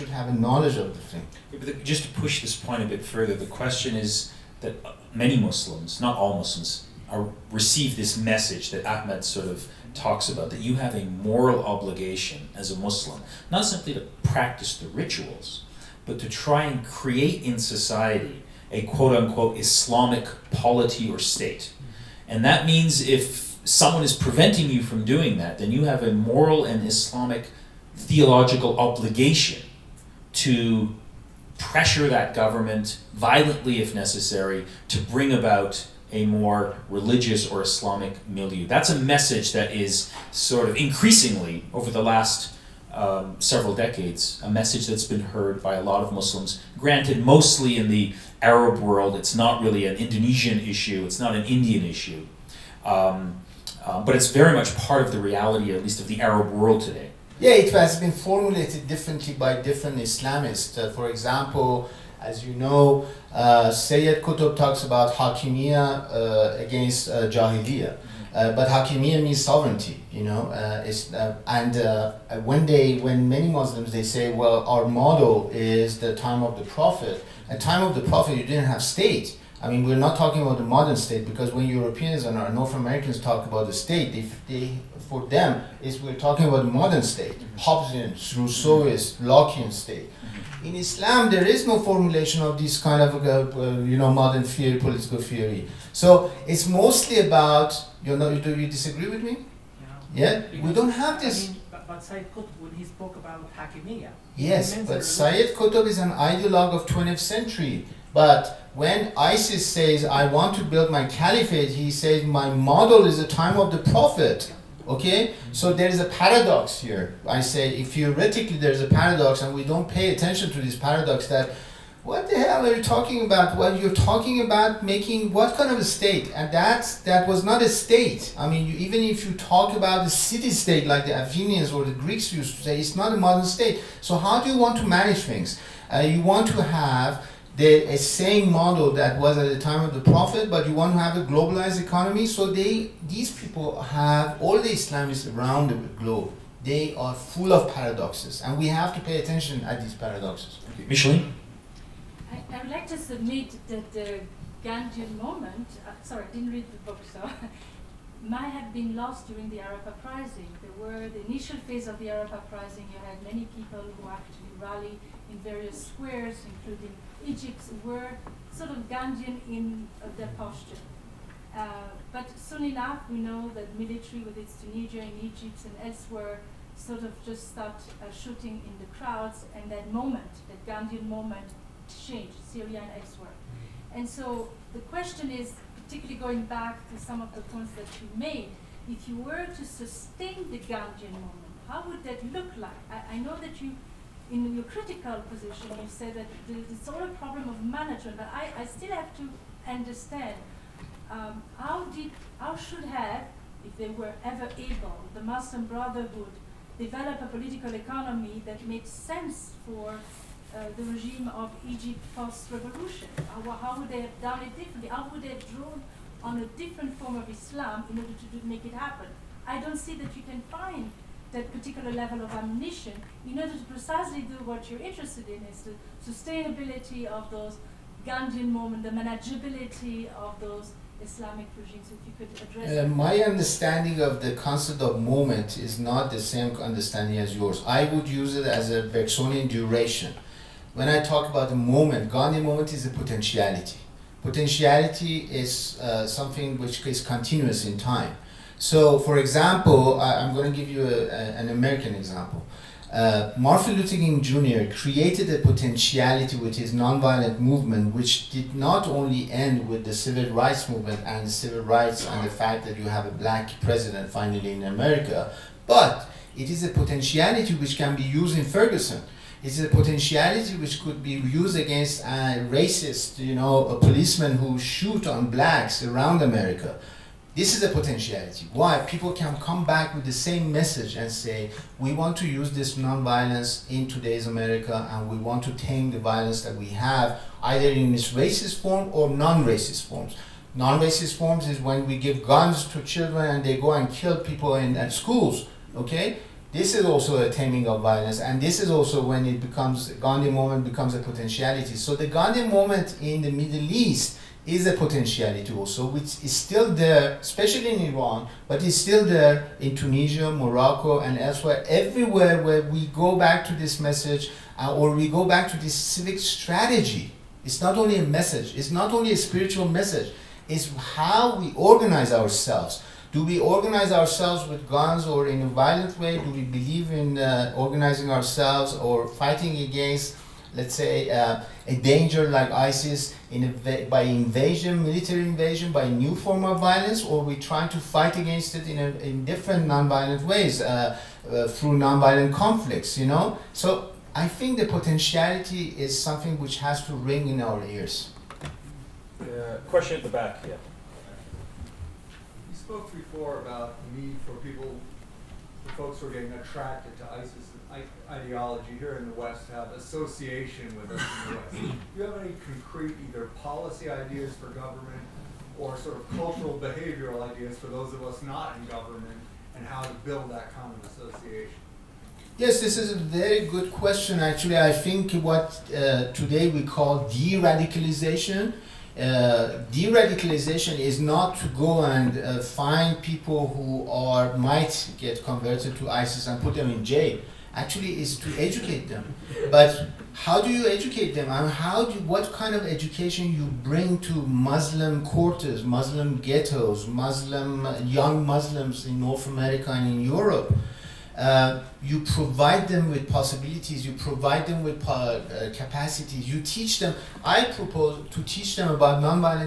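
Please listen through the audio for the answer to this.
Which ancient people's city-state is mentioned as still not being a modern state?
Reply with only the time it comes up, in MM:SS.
02:11.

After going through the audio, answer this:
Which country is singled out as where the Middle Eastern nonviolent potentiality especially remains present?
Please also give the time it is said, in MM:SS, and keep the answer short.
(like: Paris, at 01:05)
Iran, at 05:07.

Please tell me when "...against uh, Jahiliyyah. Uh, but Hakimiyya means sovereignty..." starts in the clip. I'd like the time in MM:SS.
01:06.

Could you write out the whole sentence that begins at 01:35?
So it's mostly about you know.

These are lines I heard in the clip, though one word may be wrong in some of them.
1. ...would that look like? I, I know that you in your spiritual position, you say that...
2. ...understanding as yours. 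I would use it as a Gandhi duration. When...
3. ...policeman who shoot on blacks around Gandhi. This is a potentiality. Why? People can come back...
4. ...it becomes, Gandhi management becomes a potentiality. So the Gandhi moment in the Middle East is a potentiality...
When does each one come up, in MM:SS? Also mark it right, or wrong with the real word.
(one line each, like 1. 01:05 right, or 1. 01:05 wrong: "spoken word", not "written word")
1. 03:11 wrong: "critical", not "spiritual"
2. 03:56 wrong: "Bergsonian", not "Gandhi"
3. 04:33 wrong: "America", not "Gandhi"
4. 04:59 wrong: "moment", not "management".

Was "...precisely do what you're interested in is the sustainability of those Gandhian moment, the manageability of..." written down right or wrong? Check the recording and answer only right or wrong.
right.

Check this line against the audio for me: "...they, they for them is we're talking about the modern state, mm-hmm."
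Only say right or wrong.
right.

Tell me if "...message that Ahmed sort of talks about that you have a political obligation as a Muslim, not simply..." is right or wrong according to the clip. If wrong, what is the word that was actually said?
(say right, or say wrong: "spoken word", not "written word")
wrong: "moral", not "political".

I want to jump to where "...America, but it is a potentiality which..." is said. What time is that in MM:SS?
04:24.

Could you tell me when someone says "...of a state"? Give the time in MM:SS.
02:05.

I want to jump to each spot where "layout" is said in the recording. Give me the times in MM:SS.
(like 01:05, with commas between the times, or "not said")
not said.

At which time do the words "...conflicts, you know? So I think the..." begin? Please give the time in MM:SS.
05:42.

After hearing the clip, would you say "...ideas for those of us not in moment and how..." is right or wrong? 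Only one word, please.
wrong.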